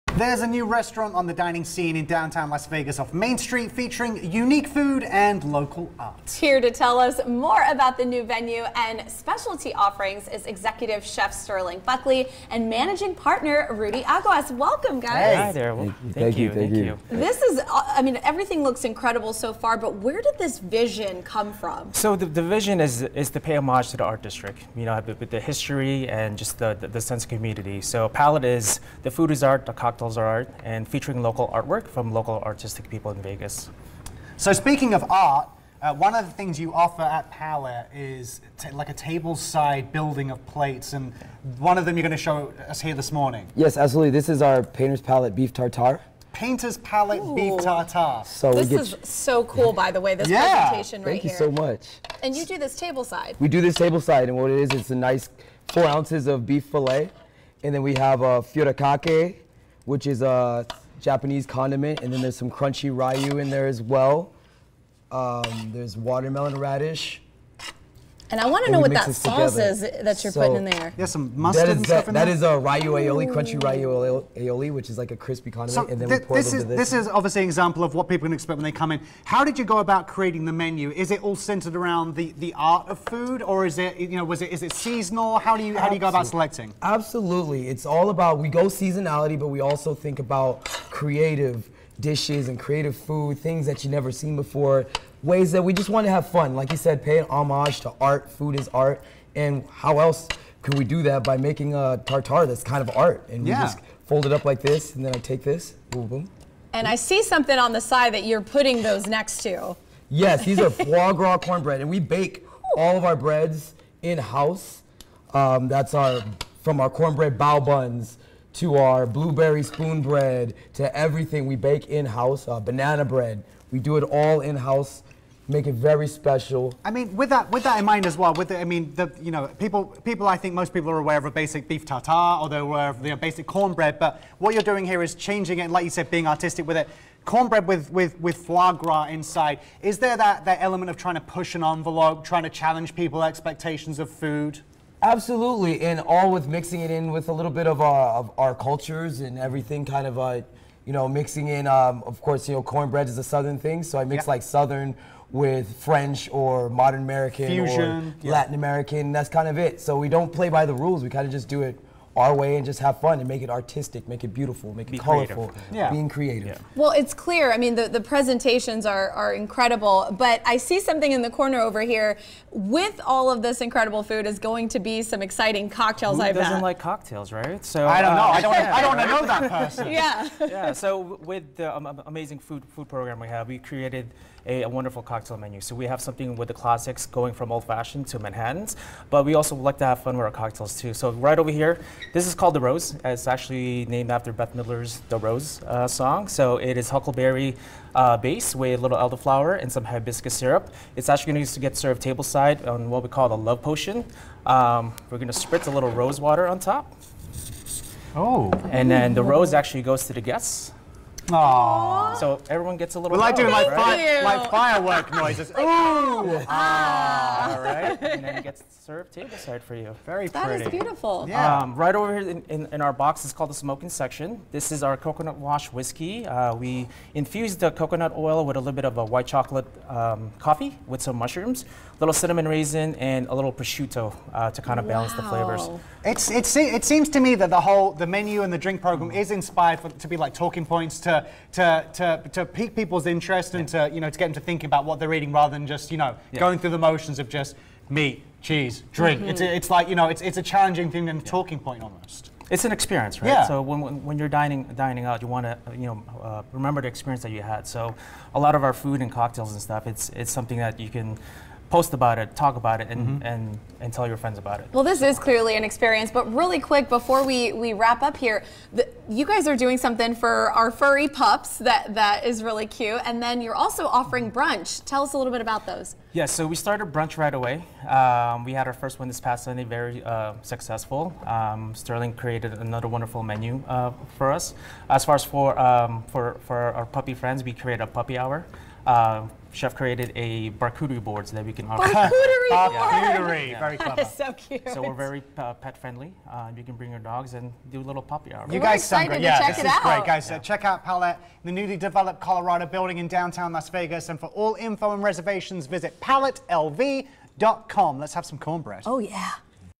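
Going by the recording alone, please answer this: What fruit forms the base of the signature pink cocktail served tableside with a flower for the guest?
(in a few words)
Huckleberry.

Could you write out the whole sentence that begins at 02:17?
Cornbread with, with, with foie gras inside.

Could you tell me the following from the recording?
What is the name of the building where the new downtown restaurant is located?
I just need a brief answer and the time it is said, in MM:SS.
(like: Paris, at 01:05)
Colorado building, at 05:02.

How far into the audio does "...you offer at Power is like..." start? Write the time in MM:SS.
00:36.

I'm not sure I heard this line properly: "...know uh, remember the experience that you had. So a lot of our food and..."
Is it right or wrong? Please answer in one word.
right.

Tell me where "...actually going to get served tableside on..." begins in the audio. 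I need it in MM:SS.
03:21.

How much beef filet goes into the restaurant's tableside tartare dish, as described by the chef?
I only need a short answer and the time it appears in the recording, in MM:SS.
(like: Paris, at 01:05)
4 ounces, at 00:55.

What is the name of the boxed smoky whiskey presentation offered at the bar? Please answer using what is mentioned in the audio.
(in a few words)
The smoking section.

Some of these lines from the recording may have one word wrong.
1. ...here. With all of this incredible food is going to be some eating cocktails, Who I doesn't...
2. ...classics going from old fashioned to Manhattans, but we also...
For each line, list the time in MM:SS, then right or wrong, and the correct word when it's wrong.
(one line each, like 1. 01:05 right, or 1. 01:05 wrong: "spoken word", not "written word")
1. 02:51 wrong: "exciting", not "eating"
2. 03:06 right.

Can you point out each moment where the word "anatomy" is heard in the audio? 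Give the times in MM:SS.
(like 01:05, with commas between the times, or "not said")
not said.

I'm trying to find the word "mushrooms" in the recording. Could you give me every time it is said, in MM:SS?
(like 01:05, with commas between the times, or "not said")
03:51.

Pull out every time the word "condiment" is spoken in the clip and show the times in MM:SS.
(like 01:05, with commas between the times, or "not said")
01:01, 01:15.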